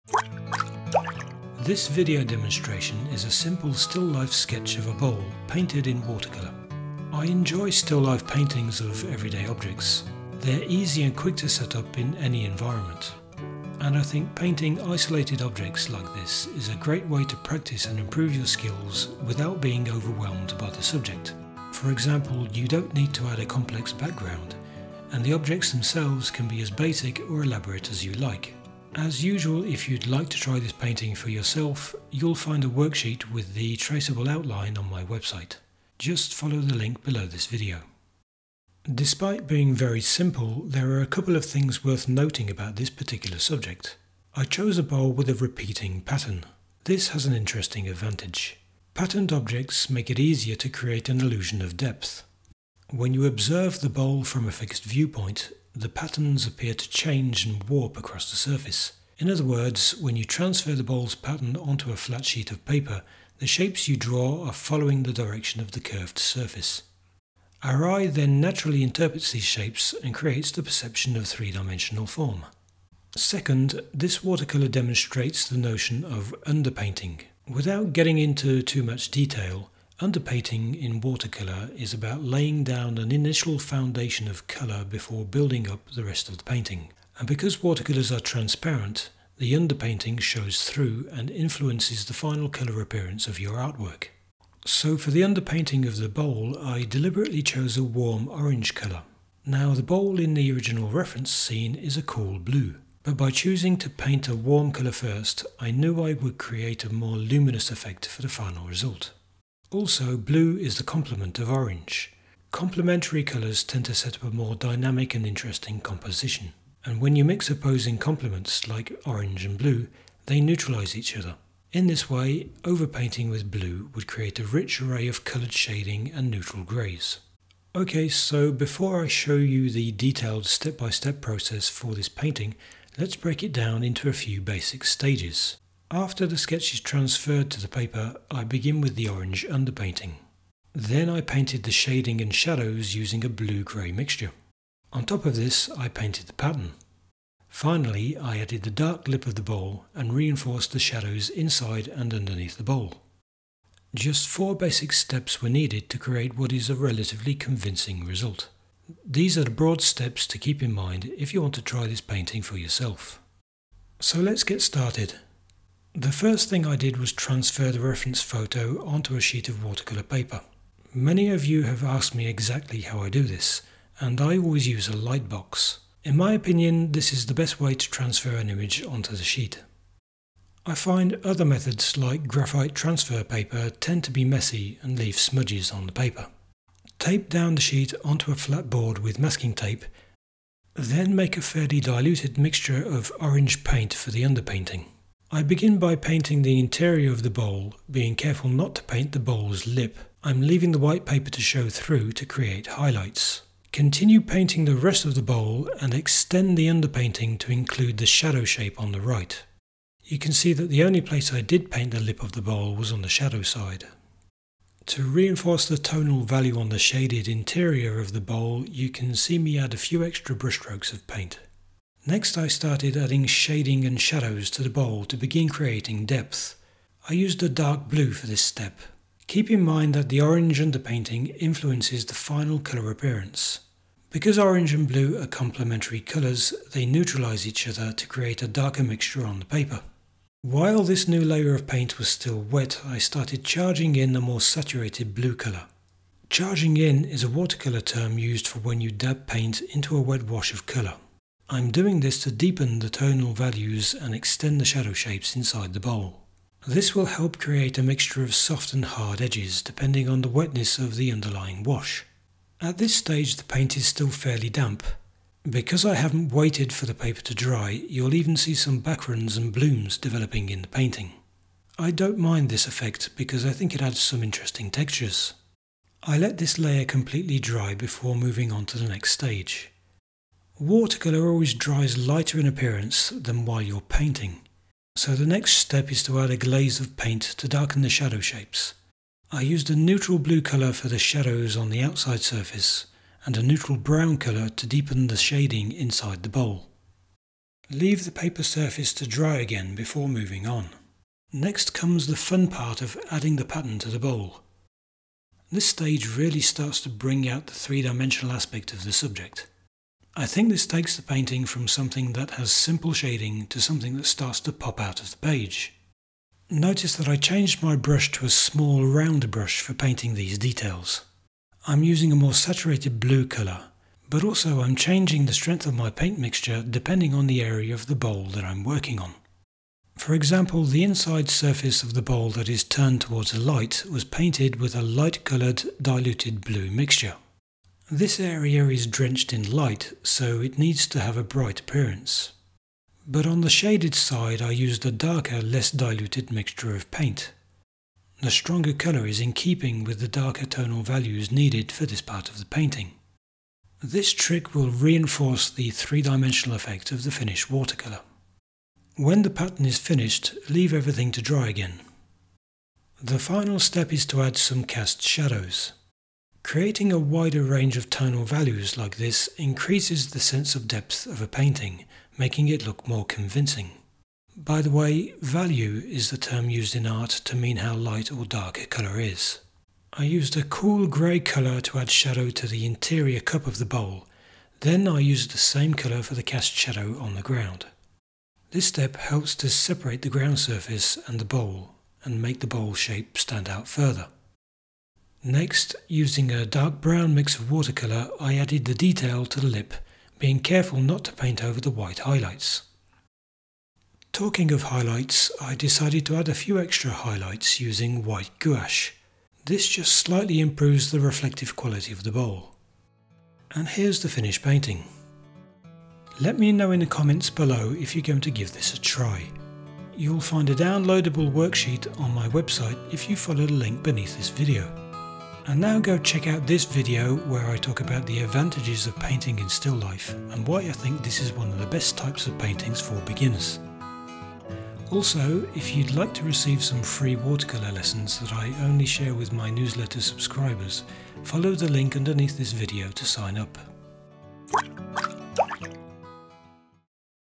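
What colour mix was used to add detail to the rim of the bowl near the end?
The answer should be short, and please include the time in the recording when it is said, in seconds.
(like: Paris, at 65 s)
Dark brown, at 396 s.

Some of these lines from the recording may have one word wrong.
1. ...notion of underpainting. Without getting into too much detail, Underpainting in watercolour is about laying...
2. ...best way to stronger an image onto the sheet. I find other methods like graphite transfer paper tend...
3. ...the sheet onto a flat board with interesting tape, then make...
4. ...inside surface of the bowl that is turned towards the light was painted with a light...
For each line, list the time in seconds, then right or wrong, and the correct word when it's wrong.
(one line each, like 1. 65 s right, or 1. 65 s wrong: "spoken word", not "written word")
1. 75 s right
2. 177 s wrong: "transfer", not "stronger"
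3. 187 s wrong: "masking", not "interesting"
4. 330 s right.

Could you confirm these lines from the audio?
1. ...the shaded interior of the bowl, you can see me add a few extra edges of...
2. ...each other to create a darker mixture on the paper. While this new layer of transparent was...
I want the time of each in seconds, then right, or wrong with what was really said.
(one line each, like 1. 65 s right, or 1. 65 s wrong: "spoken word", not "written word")
1. 216 s wrong: "brushstrokes", not "edges"
2. 237 s wrong: "paint", not "transparent".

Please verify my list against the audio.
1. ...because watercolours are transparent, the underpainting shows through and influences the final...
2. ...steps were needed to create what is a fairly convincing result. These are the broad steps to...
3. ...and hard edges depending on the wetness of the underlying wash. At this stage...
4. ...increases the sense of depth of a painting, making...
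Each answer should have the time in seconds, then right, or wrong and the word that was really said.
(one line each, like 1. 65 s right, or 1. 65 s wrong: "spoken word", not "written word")
1. 87 s right
2. 154 s wrong: "relatively", not "fairly"
3. 258 s right
4. 369 s right.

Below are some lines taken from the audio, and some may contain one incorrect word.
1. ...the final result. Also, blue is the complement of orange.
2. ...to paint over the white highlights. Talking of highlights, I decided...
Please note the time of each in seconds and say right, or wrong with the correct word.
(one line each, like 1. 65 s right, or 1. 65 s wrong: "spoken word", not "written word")
1. 108 s right
2. 401 s right.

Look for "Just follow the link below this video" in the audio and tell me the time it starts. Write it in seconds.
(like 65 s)
35 s.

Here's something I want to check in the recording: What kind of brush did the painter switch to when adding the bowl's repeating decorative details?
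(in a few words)
Small round brush.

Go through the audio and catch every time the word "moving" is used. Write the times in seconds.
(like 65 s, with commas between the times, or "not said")
278 s, 300 s.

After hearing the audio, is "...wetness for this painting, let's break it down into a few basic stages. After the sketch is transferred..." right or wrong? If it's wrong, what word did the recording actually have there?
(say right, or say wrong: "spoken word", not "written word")
wrong: "process", not "wetness".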